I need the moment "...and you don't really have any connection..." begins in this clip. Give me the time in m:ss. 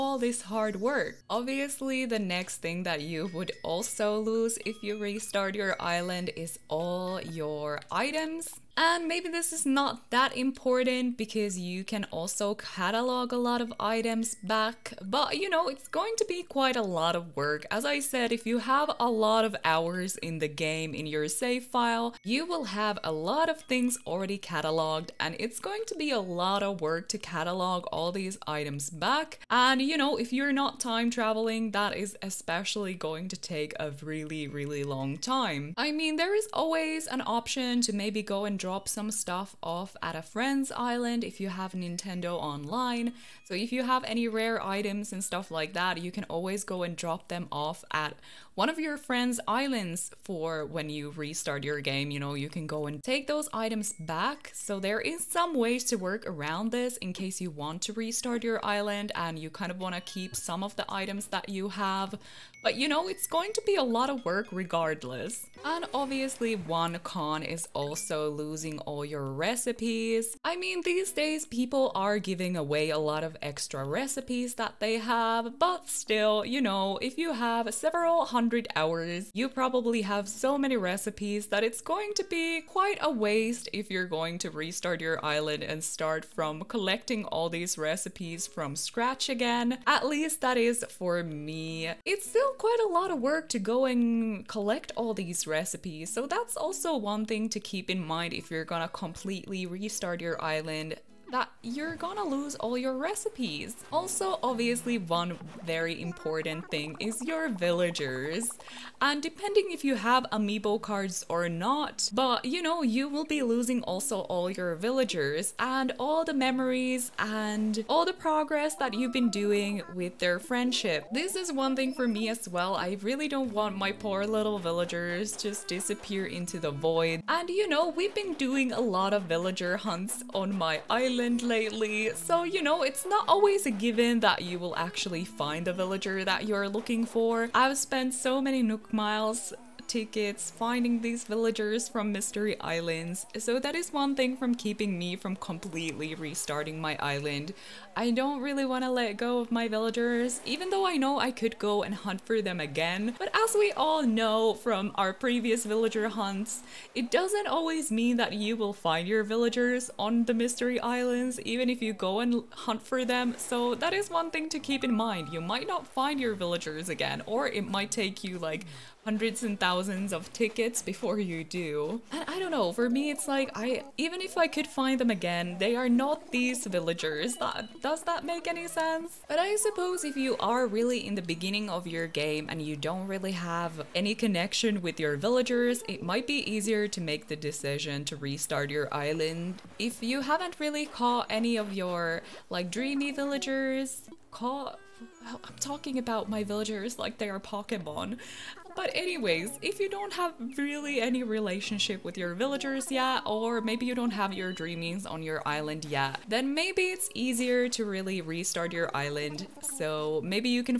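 3:02.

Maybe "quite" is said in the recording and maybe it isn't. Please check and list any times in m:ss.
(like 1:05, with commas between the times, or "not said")
0:16, 1:22, 1:32.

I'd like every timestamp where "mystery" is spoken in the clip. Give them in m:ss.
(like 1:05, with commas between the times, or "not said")
2:22, 2:40.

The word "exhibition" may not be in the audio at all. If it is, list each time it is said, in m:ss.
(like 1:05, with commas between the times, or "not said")
not said.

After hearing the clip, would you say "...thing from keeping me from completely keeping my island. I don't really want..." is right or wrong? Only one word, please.
wrong.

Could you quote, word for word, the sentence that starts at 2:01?
This is one thing for me as well.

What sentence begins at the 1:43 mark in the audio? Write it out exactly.
Also, obviously, one very important thing is your villagers.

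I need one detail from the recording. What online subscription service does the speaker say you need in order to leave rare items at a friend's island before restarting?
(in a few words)
Nintendo online.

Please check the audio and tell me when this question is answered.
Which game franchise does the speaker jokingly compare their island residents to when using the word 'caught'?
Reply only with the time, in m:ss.
3:17.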